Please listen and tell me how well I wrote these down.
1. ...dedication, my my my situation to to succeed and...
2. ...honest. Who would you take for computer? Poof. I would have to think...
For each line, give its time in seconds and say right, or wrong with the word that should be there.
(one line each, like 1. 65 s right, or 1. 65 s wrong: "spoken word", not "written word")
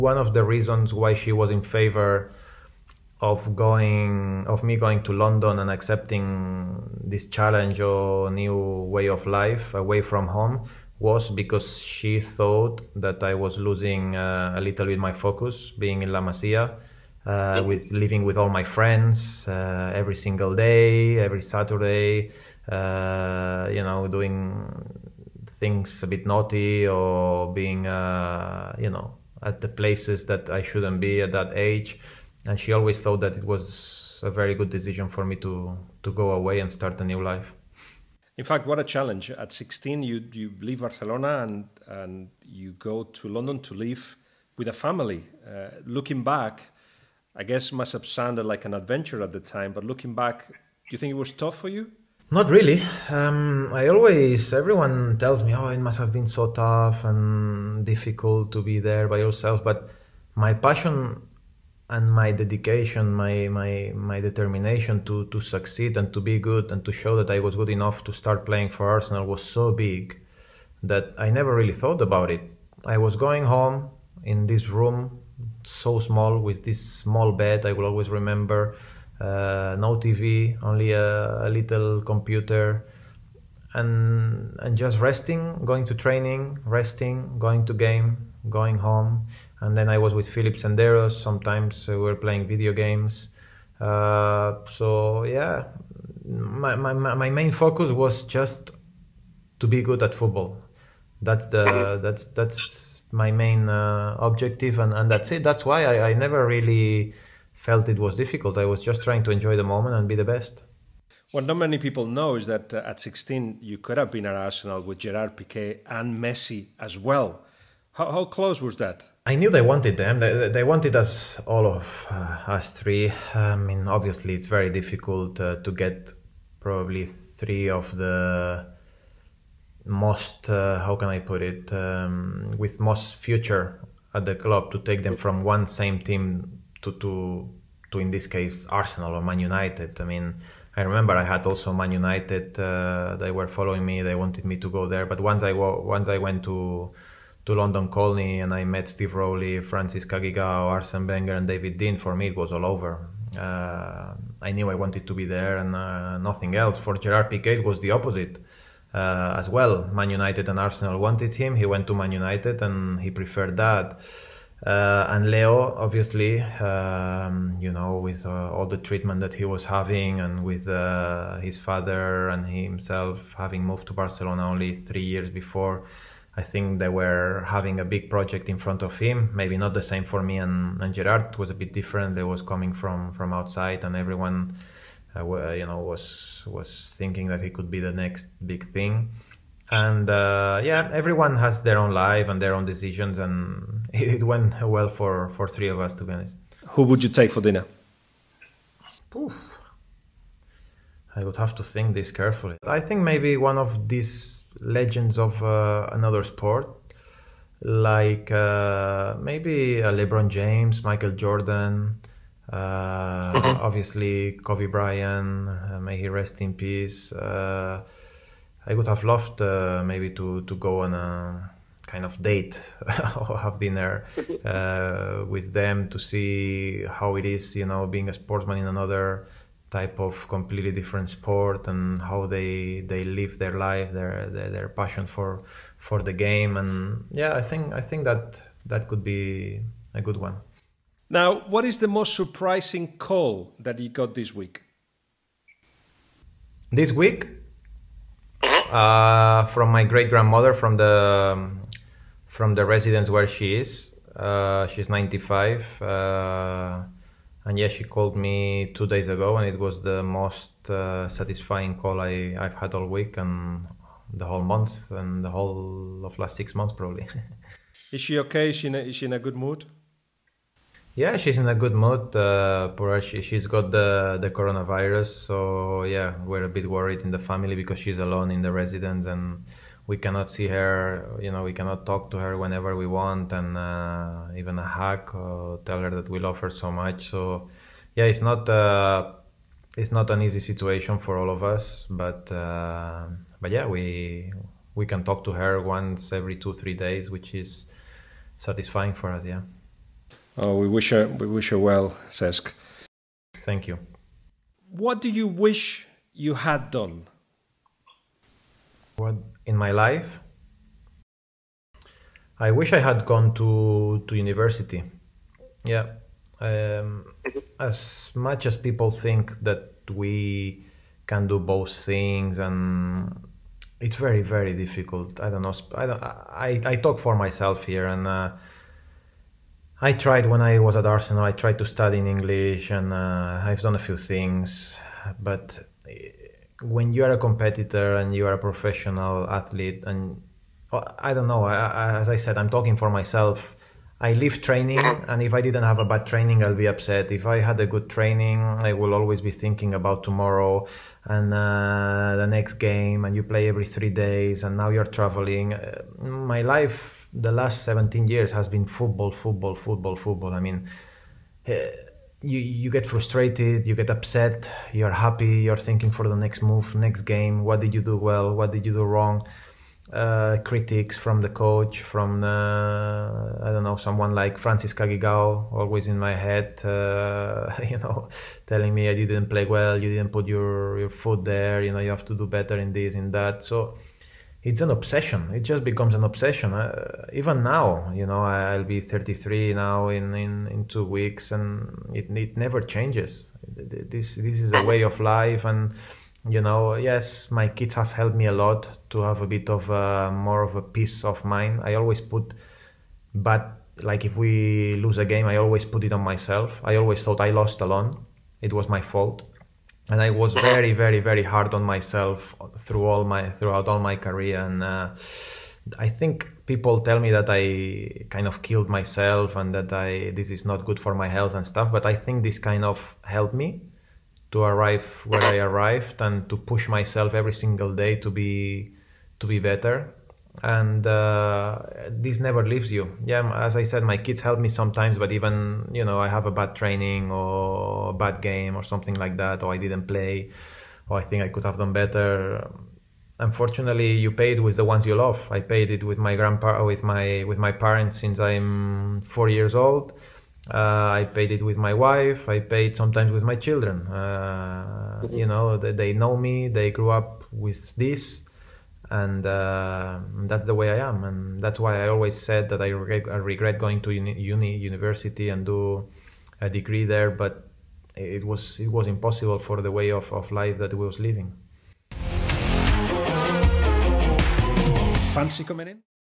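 1. 62 s wrong: "determination", not "situation"
2. 196 s wrong: "dinner", not "computer".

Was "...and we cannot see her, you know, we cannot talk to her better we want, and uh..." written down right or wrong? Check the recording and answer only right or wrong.
wrong.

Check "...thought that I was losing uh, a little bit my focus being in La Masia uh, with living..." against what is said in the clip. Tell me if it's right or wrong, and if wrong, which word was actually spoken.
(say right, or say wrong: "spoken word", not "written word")
right.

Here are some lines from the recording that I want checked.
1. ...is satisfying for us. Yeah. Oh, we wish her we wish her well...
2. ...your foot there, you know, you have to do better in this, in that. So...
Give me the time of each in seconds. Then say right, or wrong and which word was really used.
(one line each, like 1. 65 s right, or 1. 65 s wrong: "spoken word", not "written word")
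1. 297 s right
2. 380 s right.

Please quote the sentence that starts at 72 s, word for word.
I was going home in this room so small with this small bed.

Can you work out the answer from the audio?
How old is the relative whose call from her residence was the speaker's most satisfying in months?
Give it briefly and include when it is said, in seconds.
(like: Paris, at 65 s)
95, at 254 s.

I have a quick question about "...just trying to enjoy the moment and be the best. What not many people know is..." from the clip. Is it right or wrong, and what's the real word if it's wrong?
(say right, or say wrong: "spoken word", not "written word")
right.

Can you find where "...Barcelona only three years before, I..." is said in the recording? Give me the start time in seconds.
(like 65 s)
173 s.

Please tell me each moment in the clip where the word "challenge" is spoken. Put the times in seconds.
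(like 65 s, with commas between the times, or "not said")
7 s, 38 s.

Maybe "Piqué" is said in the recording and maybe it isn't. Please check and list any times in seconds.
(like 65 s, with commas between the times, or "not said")
115 s, 157 s.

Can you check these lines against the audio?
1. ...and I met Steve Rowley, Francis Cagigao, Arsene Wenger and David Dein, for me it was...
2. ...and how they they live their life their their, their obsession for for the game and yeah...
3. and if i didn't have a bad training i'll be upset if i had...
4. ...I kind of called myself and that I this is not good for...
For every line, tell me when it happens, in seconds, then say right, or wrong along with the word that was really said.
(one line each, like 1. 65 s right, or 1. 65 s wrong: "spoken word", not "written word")
1. 148 s right
2. 231 s wrong: "passion", not "obsession"
3. 345 s right
4. 417 s wrong: "killed", not "called".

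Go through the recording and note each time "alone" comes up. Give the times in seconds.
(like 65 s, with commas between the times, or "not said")
277 s, 407 s.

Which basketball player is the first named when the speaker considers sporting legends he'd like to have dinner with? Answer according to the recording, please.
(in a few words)
LeBron James.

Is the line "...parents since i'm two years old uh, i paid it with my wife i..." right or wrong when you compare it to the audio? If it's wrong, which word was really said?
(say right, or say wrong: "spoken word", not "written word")
wrong: "four", not "two".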